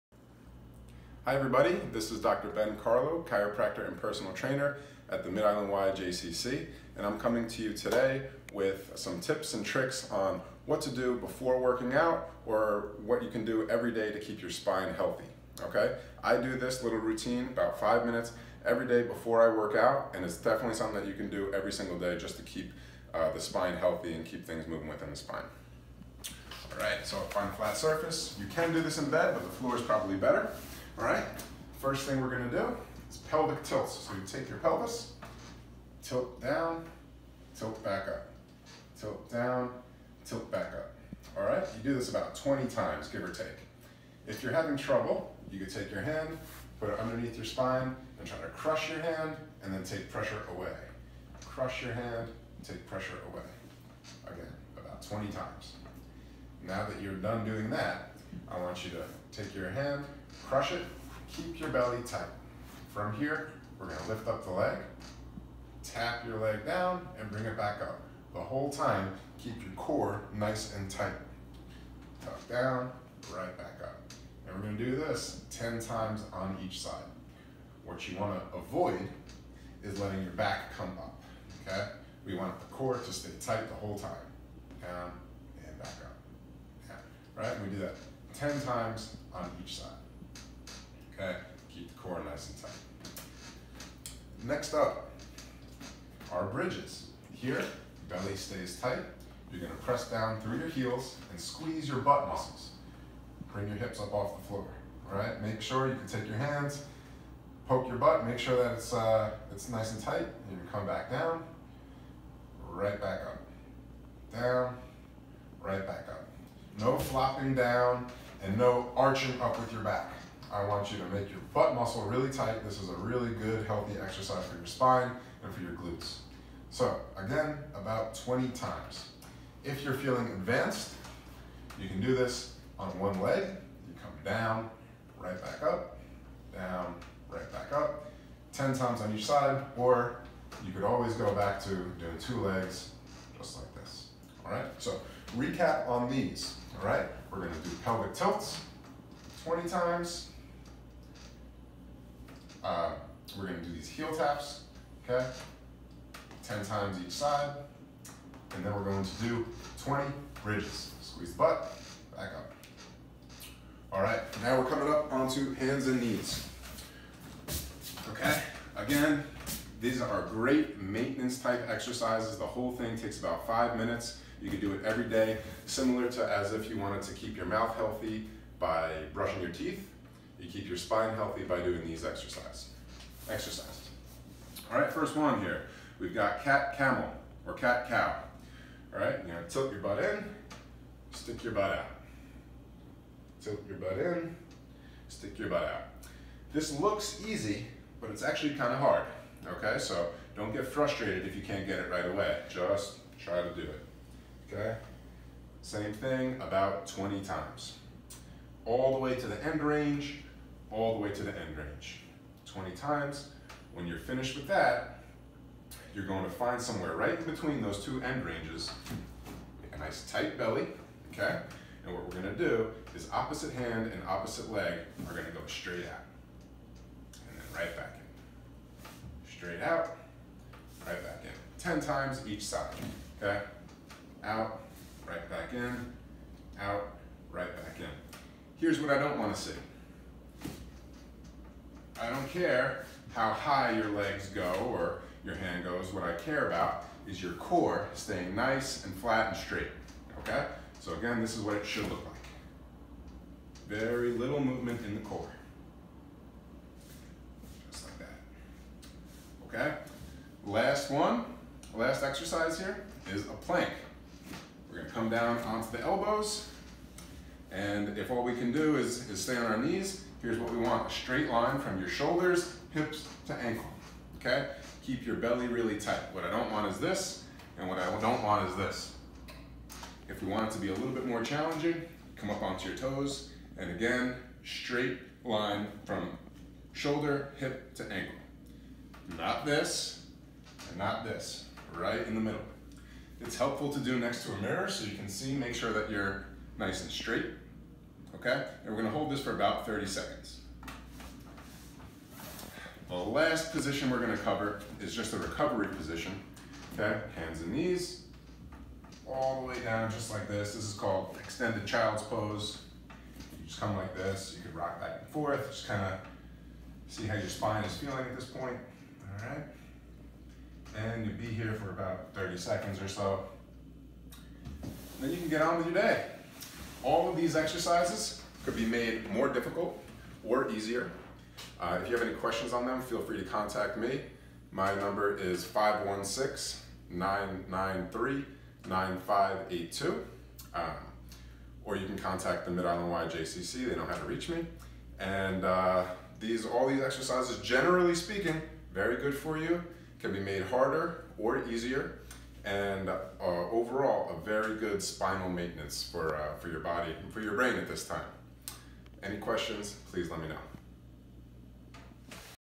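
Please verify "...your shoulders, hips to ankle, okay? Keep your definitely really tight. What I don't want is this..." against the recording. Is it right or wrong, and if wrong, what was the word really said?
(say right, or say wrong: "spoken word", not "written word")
wrong: "belly", not "definitely".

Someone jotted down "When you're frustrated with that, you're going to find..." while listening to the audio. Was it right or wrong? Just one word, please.
wrong.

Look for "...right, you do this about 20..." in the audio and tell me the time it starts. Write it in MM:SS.
00:41.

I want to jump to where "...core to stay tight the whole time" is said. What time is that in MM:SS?
01:22.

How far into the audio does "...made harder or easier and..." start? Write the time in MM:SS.
05:50.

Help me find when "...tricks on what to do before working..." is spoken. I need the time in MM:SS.
00:09.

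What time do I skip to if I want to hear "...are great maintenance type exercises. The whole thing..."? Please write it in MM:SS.
02:50.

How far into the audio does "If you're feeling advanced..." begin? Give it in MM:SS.
02:09.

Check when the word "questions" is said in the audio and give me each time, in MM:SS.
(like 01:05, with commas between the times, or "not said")
05:32, 05:59.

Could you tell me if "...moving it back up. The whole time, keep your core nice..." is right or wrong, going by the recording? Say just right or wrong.
wrong.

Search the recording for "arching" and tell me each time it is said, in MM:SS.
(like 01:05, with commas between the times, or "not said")
01:58.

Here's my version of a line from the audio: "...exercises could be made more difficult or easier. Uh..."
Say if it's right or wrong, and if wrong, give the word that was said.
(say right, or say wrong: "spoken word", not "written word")
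right.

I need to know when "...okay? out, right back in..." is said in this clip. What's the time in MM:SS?
03:53.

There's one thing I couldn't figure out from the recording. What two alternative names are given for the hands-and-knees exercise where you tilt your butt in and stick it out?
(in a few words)
cat camel or cat cow.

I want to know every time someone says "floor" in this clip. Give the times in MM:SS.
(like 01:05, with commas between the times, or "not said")
00:29, 01:44.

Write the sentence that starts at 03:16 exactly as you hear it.
This looks easy, but it's actually kind of hard.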